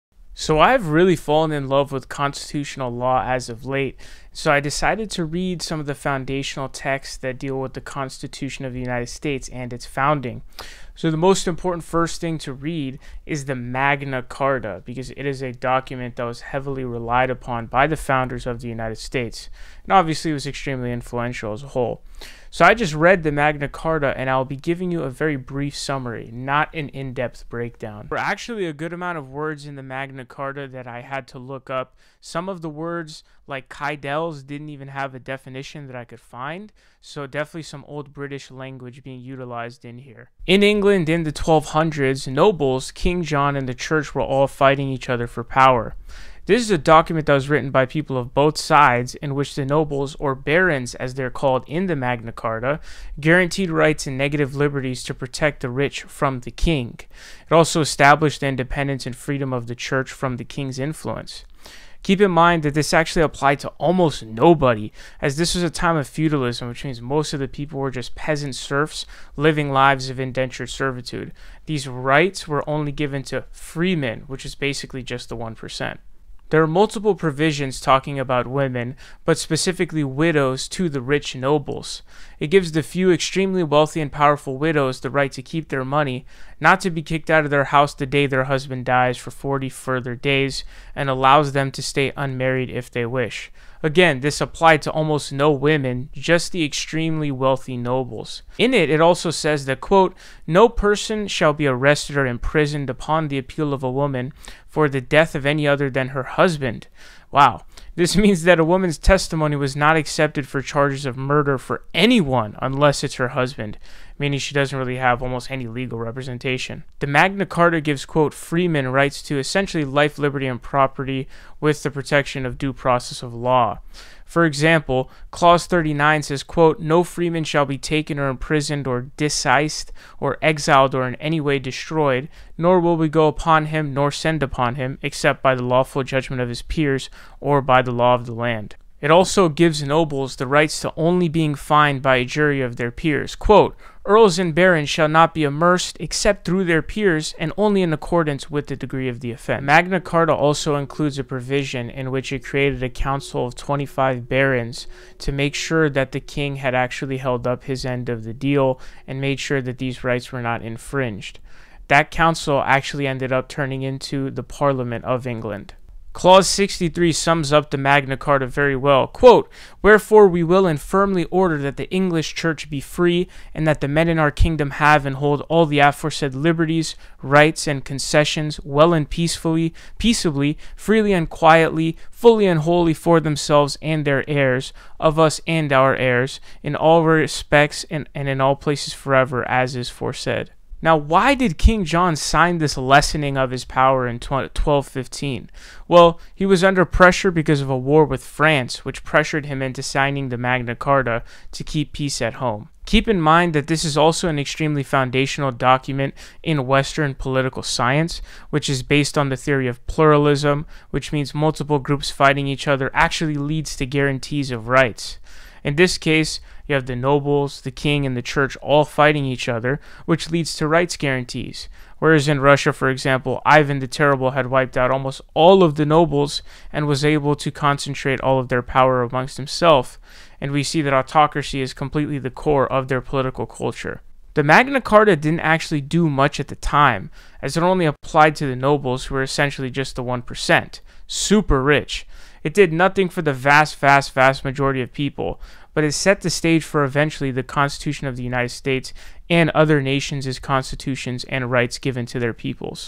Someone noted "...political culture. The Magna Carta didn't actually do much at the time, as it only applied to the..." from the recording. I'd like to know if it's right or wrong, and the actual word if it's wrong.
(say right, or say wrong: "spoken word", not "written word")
right.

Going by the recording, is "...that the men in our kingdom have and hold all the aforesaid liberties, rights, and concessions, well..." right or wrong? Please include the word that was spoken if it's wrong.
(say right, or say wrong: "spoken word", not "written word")
right.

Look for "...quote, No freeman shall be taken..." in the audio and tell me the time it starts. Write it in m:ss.
2:06.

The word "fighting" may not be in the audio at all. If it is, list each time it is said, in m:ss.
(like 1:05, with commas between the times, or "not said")
0:44, 3:32, 3:38.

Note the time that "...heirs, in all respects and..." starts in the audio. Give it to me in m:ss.
3:05.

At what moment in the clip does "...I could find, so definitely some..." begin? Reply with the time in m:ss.
0:35.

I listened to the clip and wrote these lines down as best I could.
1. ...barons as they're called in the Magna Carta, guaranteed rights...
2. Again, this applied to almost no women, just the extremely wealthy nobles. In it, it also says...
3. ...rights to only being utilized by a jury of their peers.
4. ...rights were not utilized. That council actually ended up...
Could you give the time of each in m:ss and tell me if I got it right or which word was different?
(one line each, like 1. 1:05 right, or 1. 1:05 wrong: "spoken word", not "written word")
1. 0:50 right
2. 1:33 right
3. 2:20 wrong: "fined", not "utilized"
4. 2:40 wrong: "infringed", not "utilized".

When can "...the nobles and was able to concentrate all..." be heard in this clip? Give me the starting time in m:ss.
3:45.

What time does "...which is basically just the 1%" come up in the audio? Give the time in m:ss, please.
1:14.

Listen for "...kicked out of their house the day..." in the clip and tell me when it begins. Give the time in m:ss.
1:27.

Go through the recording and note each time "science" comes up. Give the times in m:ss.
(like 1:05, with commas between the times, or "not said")
3:27.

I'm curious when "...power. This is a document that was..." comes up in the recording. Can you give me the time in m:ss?
0:45.